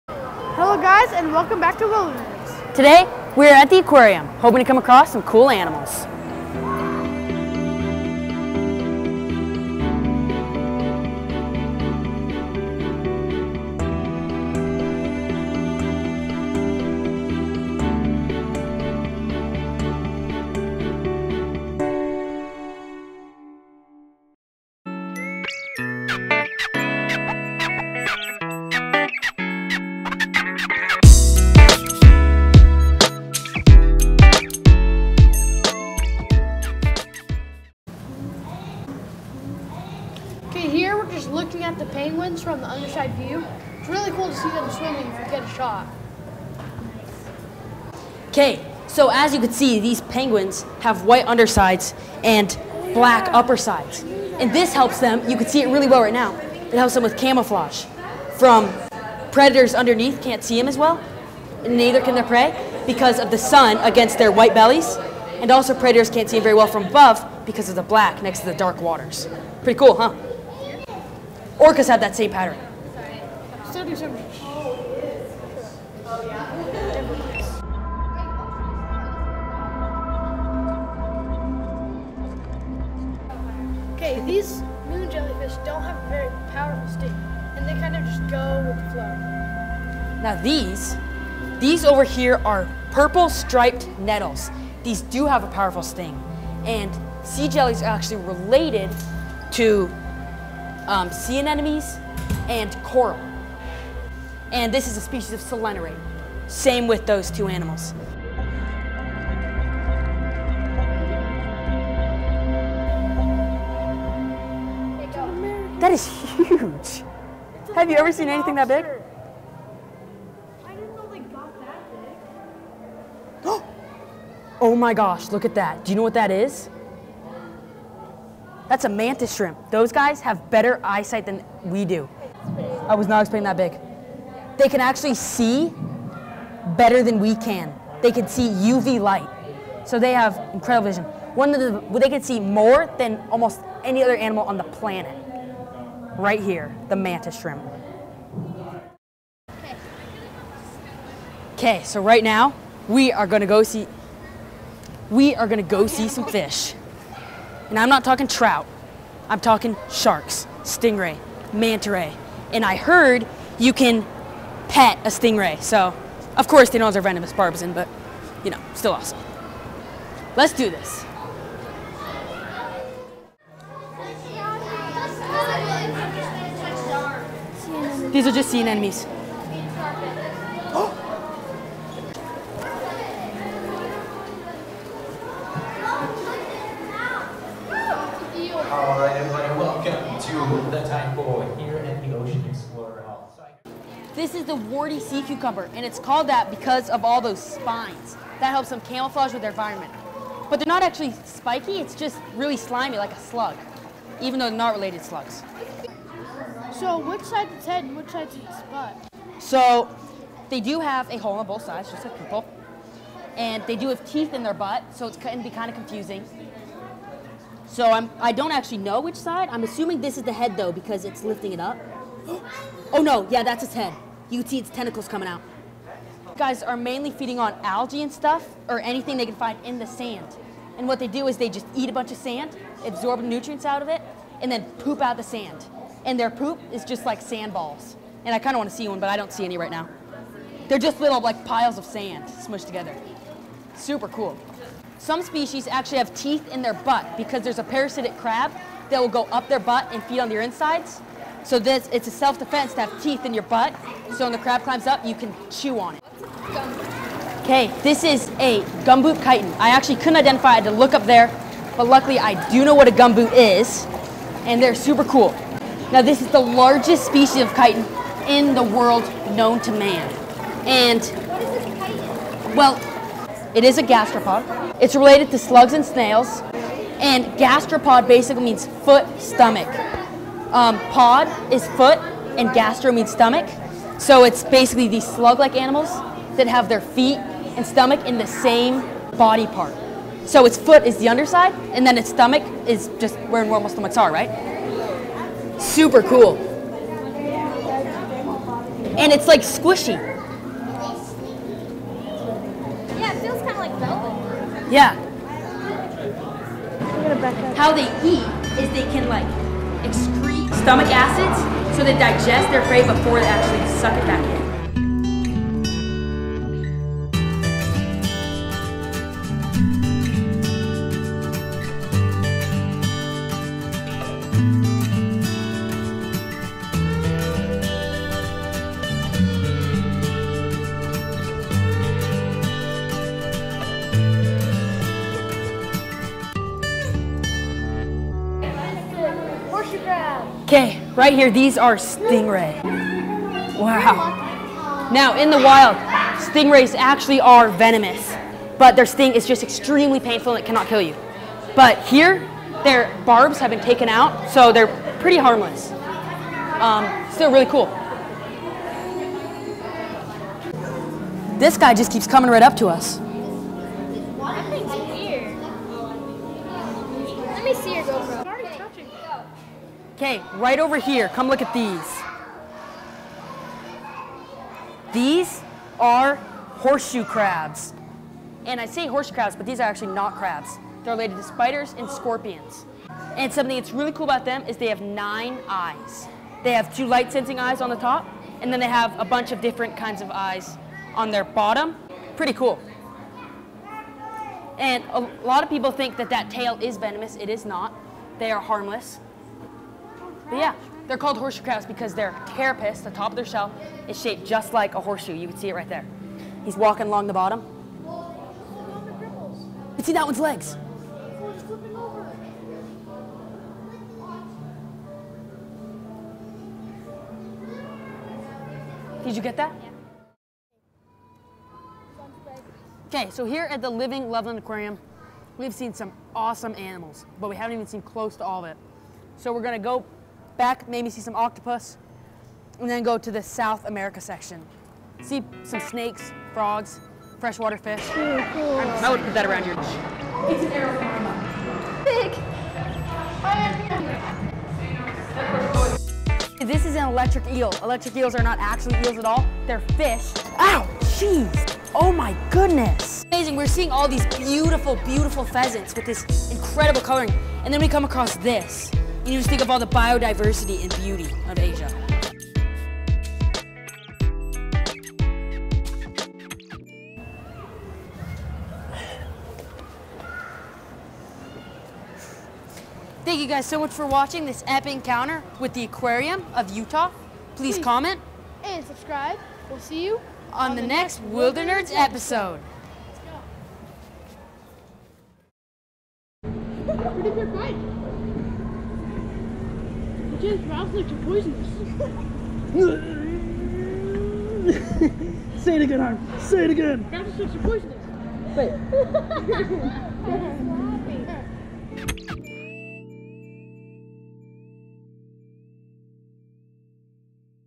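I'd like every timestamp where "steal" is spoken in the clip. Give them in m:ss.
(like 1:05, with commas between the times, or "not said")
not said.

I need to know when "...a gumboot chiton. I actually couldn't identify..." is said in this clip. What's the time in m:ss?
4:18.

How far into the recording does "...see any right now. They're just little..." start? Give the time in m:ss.
3:59.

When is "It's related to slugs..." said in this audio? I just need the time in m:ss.
4:34.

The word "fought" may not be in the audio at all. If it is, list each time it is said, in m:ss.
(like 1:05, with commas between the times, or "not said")
not said.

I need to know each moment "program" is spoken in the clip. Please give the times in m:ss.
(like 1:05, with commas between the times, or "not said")
not said.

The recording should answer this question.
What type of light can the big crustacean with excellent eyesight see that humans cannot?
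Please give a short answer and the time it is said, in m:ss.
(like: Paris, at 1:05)
UV light, at 2:18.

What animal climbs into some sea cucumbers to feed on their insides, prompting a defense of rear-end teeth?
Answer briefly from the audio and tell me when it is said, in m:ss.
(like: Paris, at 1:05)
Parasitic crab, at 4:07.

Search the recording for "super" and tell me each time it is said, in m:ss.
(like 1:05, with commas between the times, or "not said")
4:03, 4:24, 4:55.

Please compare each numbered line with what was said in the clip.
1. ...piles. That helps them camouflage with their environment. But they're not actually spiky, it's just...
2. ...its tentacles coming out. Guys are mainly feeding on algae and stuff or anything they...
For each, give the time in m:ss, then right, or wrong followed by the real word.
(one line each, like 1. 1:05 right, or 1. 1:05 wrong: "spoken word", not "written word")
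1. 3:17 wrong: "spines", not "piles"
2. 3:44 right.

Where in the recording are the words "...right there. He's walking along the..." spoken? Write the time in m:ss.
6:45.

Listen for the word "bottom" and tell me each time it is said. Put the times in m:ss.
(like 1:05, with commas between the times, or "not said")
6:31, 6:47.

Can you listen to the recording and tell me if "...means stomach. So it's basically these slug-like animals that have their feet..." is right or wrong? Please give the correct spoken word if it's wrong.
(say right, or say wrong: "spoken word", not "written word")
right.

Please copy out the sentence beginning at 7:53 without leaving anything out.
Thank you guys so much for watching this epic encounter with the Aquarium of Utah.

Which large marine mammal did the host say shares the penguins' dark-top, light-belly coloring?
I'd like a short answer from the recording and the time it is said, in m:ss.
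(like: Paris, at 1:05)
Orcas, at 1:11.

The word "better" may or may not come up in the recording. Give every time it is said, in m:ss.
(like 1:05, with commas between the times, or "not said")
2:10, 2:16.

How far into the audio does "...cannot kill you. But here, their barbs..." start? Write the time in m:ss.
5:50.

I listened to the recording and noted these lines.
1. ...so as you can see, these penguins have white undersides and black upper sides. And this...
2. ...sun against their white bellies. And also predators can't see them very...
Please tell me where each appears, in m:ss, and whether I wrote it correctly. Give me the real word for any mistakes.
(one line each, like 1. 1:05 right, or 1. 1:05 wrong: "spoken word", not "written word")
1. 0:48 right
2. 1:03 right.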